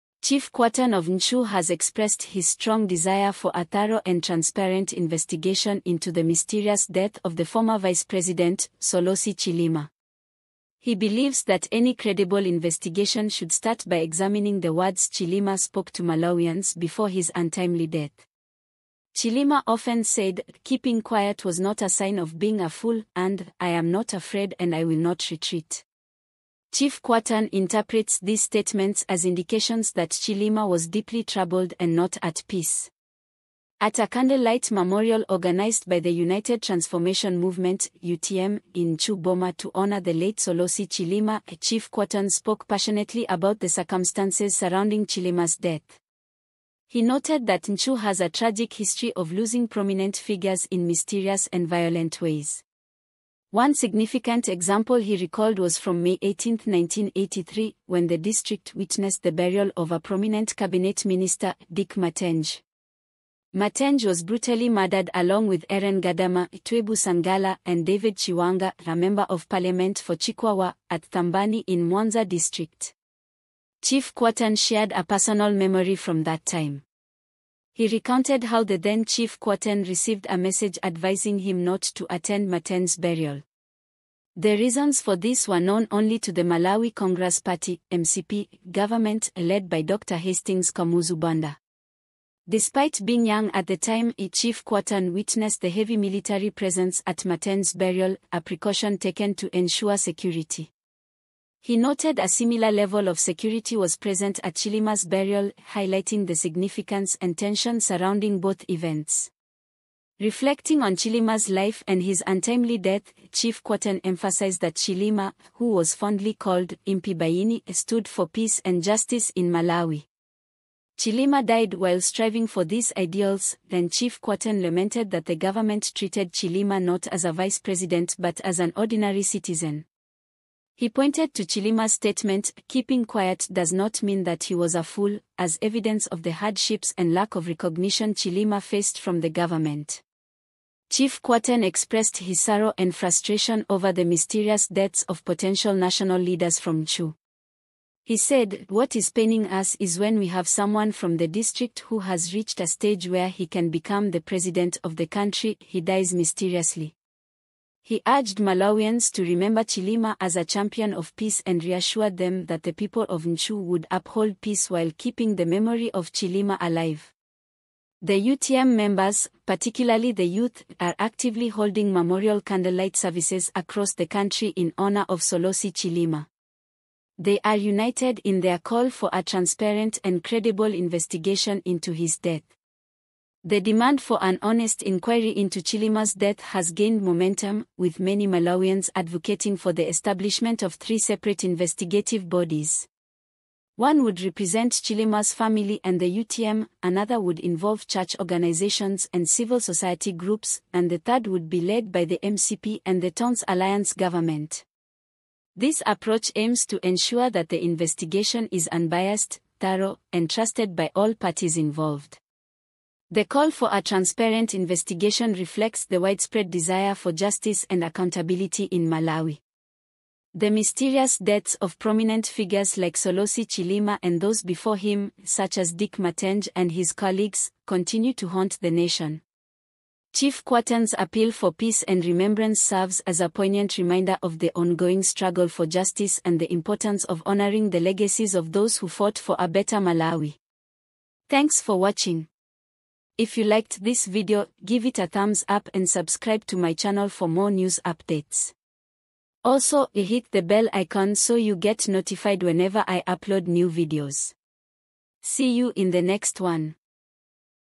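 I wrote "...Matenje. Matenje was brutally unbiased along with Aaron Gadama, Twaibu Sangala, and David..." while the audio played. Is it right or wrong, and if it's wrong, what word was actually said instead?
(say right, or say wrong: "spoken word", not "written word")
wrong: "murdered", not "unbiased".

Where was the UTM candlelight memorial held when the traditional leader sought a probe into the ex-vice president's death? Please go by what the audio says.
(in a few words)
Chuboma.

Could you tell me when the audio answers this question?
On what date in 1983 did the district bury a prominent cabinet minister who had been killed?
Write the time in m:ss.
0:56.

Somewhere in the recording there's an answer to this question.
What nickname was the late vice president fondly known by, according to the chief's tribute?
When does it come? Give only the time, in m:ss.
1:56.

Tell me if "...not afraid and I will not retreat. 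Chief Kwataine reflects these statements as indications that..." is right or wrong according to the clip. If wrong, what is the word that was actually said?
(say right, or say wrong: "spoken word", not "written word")
wrong: "interprets", not "reflects".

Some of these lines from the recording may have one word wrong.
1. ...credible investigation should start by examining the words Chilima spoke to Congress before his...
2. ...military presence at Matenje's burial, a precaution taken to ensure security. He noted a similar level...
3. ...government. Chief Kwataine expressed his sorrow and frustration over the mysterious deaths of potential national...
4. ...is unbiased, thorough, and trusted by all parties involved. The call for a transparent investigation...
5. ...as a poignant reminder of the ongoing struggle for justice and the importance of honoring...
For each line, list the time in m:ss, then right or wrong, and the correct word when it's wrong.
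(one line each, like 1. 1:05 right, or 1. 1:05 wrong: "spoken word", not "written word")
1. 0:11 wrong: "Malawians", not "Congress"
2. 1:35 right
3. 2:19 right
4. 3:28 right
5. 3:53 right.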